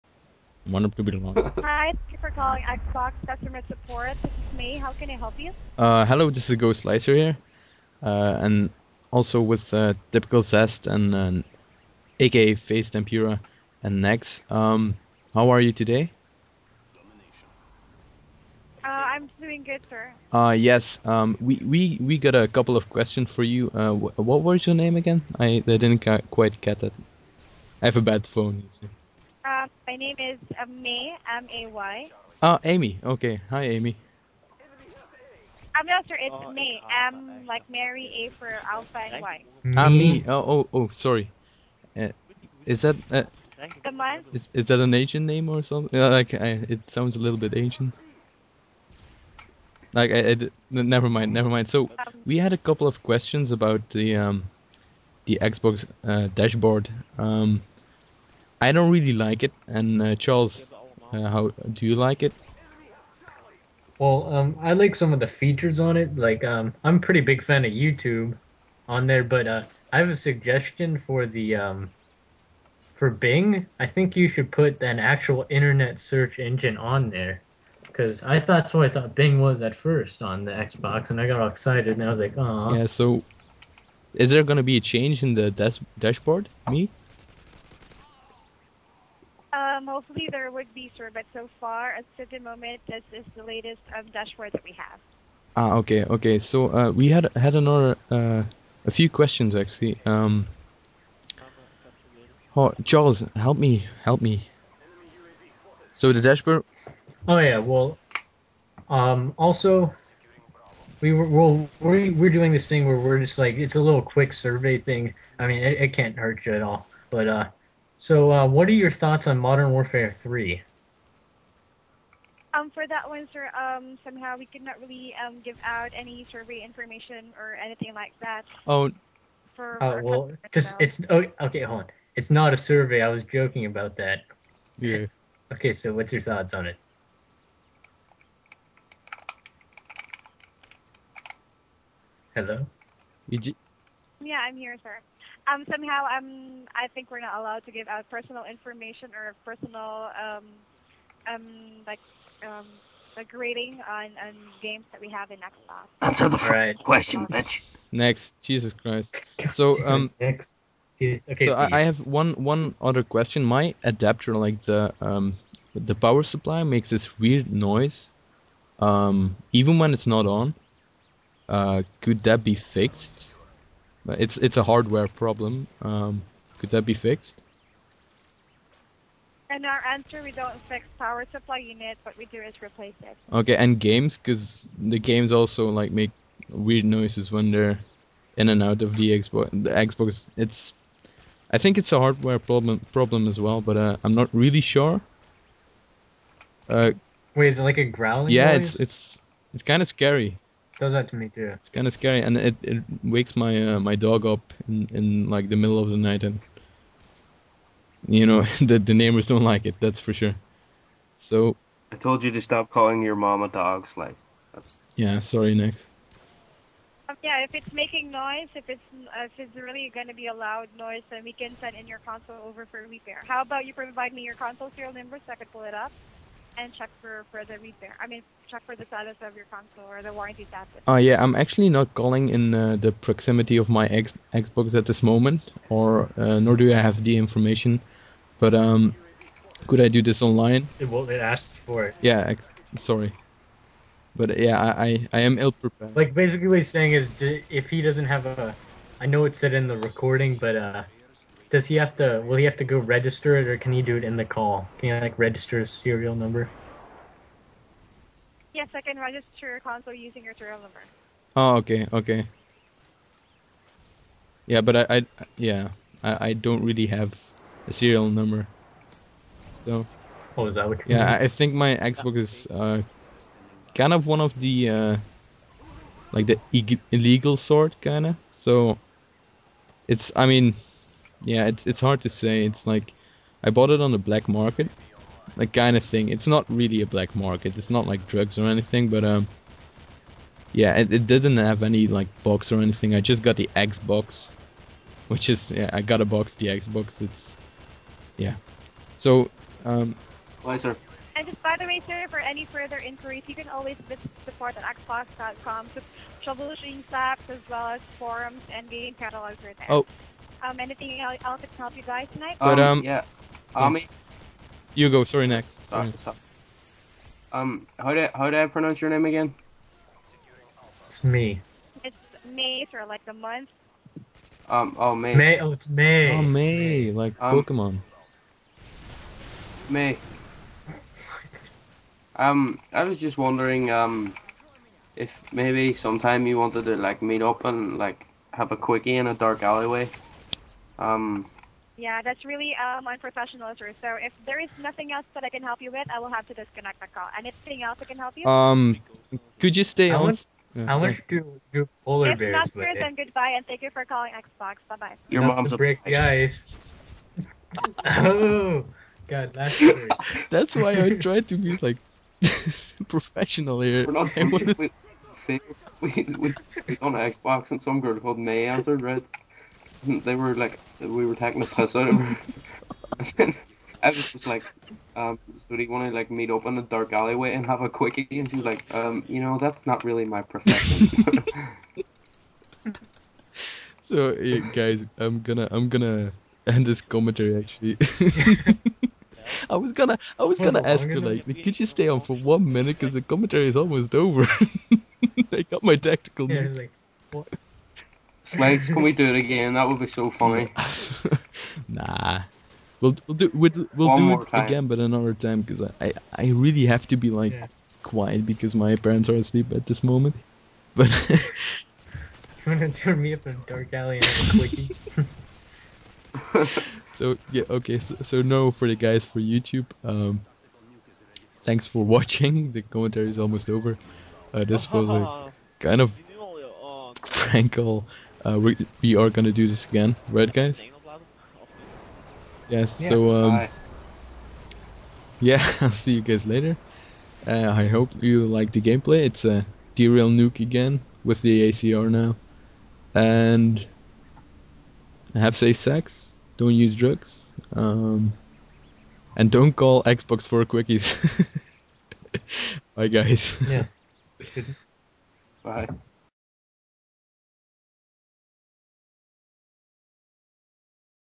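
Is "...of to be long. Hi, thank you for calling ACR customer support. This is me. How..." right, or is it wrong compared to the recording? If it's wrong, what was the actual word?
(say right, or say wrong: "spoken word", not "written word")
wrong: "Xbox", not "ACR".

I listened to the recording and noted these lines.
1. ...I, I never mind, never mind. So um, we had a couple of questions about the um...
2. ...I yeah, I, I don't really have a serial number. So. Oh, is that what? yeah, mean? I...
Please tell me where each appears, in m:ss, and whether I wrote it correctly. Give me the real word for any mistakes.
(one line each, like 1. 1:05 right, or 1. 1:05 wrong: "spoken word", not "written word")
1. 0:50 right
2. 4:24 right.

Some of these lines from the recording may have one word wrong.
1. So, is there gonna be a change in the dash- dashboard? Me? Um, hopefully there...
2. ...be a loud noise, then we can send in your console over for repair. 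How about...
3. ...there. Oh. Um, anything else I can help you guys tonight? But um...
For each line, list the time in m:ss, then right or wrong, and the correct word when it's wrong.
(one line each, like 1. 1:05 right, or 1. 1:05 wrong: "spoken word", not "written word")
1. 1:22 right
2. 3:40 right
3. 5:09 right.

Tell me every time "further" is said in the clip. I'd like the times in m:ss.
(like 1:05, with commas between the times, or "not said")
3:47, 5:02.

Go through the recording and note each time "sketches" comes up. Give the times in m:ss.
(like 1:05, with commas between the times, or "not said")
not said.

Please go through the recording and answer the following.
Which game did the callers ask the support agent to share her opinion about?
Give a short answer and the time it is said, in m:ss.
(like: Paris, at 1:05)
Modern Warfare 3, at 1:59.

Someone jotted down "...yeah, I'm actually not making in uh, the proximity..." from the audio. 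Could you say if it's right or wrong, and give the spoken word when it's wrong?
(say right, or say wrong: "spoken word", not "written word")
wrong: "calling", not "making".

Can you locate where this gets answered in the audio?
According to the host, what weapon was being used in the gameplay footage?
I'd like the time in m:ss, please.
7:21.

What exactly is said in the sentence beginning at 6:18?
And she's like, um, you know, that's not really my profession.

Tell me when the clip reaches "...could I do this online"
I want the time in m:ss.
3:59.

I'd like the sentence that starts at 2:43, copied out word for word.
My adapter, like the um, the power supply, makes this weird noise, um, even when it's not on.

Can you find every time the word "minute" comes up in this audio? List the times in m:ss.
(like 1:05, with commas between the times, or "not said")
6:32.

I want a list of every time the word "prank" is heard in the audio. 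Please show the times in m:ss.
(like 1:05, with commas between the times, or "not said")
7:07.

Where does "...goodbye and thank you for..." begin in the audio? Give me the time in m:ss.
5:52.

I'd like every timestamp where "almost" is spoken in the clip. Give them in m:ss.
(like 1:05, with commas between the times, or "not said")
6:33, 7:03.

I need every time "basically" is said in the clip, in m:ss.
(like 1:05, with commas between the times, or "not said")
4:06.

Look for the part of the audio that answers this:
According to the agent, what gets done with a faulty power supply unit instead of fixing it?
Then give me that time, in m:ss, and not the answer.
3:02.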